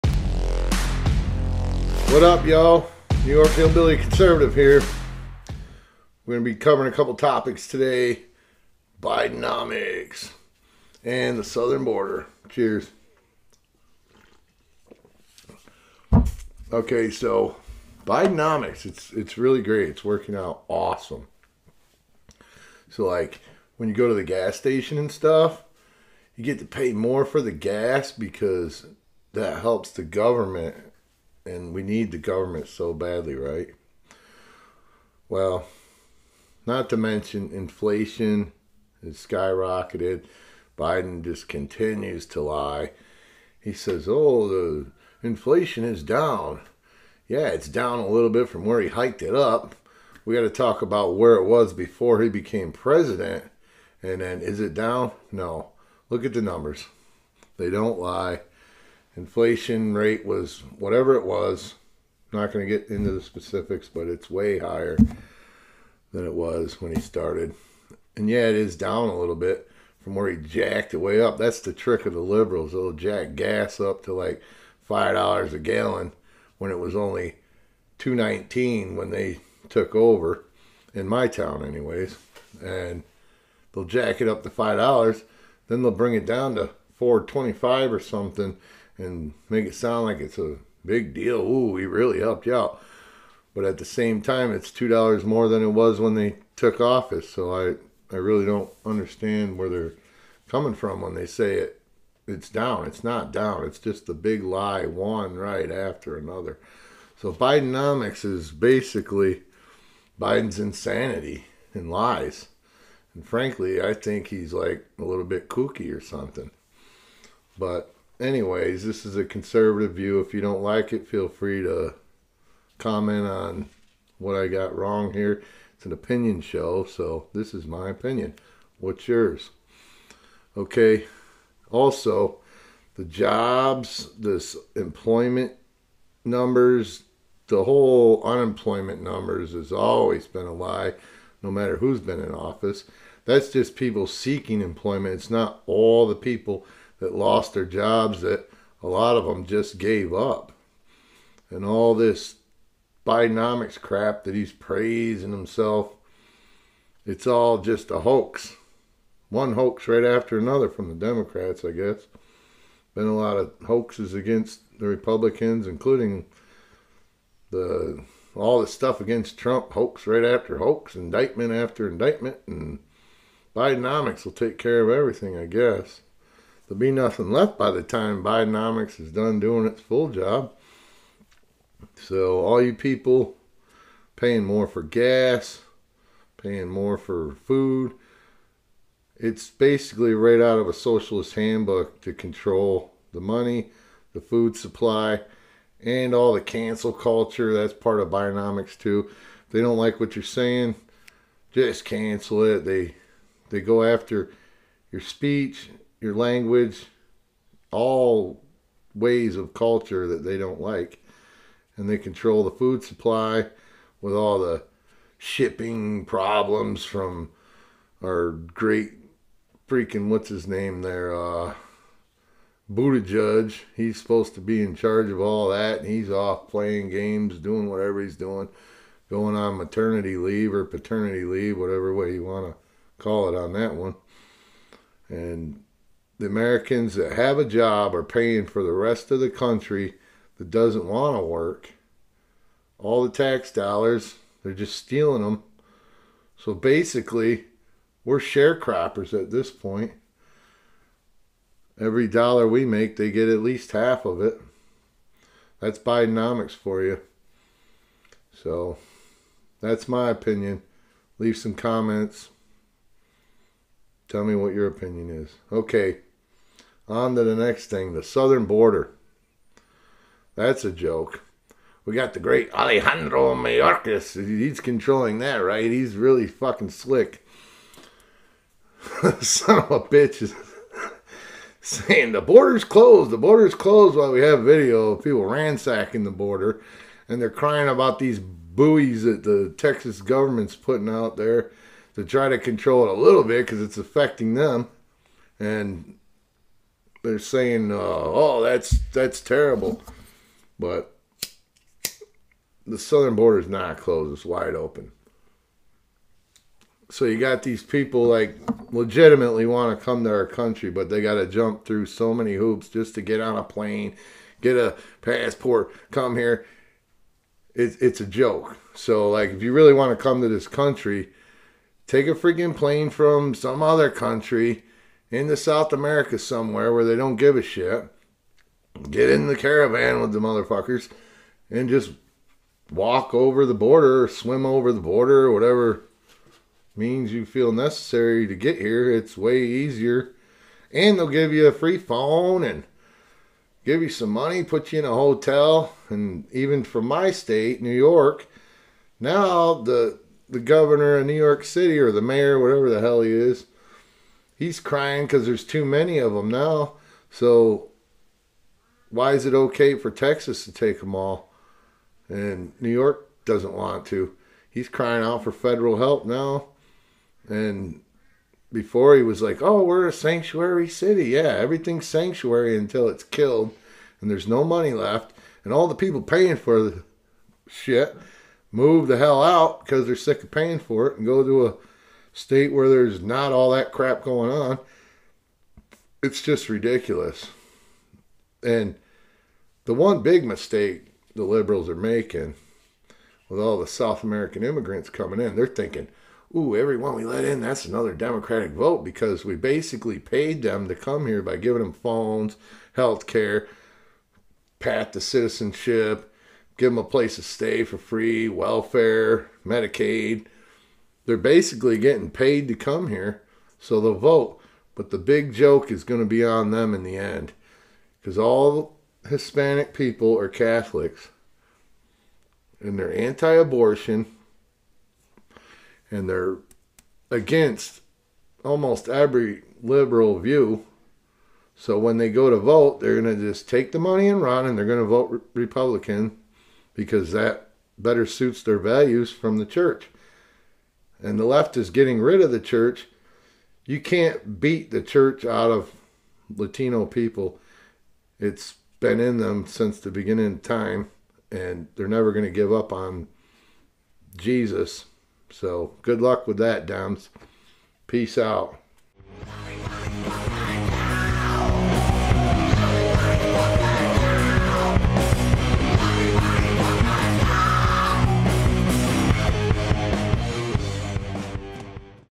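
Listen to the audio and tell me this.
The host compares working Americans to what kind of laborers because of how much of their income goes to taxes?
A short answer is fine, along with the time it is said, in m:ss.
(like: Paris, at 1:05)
sharecroppers, at 4:08.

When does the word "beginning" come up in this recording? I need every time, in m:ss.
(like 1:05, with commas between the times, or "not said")
7:29.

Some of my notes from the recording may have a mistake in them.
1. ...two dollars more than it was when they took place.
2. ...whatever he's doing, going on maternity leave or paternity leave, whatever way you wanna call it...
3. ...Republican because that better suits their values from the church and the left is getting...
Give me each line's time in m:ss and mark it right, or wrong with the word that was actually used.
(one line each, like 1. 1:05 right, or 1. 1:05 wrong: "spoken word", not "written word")
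1. 1:34 wrong: "office", not "place"
2. 3:47 right
3. 7:15 right.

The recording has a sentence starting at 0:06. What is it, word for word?
We're going to be covering a couple topics today Bidenomics and the southern border.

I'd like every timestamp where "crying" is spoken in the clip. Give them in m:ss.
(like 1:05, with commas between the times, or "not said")
4:47, 5:54, 6:04.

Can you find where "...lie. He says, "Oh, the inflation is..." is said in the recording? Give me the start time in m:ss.
0:42.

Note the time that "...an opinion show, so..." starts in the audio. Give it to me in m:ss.
2:05.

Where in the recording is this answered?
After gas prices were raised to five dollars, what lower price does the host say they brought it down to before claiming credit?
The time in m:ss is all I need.
1:27.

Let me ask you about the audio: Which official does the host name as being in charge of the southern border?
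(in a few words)
Alejandro Mayorkas.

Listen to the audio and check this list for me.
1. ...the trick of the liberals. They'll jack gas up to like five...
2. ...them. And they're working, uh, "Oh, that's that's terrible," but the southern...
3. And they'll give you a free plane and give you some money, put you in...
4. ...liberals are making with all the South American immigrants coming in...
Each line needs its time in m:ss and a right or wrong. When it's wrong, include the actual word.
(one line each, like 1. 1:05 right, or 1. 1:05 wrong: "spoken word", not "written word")
1. 1:11 right
2. 4:54 wrong: "saying", not "working"
3. 5:40 wrong: "phone", not "plane"
4. 6:31 right.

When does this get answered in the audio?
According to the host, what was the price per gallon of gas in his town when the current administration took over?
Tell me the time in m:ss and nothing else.
1:17.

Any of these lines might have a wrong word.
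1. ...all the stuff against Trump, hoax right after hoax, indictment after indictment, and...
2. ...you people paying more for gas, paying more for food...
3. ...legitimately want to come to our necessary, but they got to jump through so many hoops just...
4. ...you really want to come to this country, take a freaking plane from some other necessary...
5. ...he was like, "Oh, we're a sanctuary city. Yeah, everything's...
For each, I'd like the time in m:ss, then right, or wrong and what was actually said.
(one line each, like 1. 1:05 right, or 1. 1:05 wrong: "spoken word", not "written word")
1. 2:48 right
2. 3:02 right
3. 5:08 wrong: "country", not "necessary"
4. 5:19 wrong: "country", not "necessary"
5. 6:08 right.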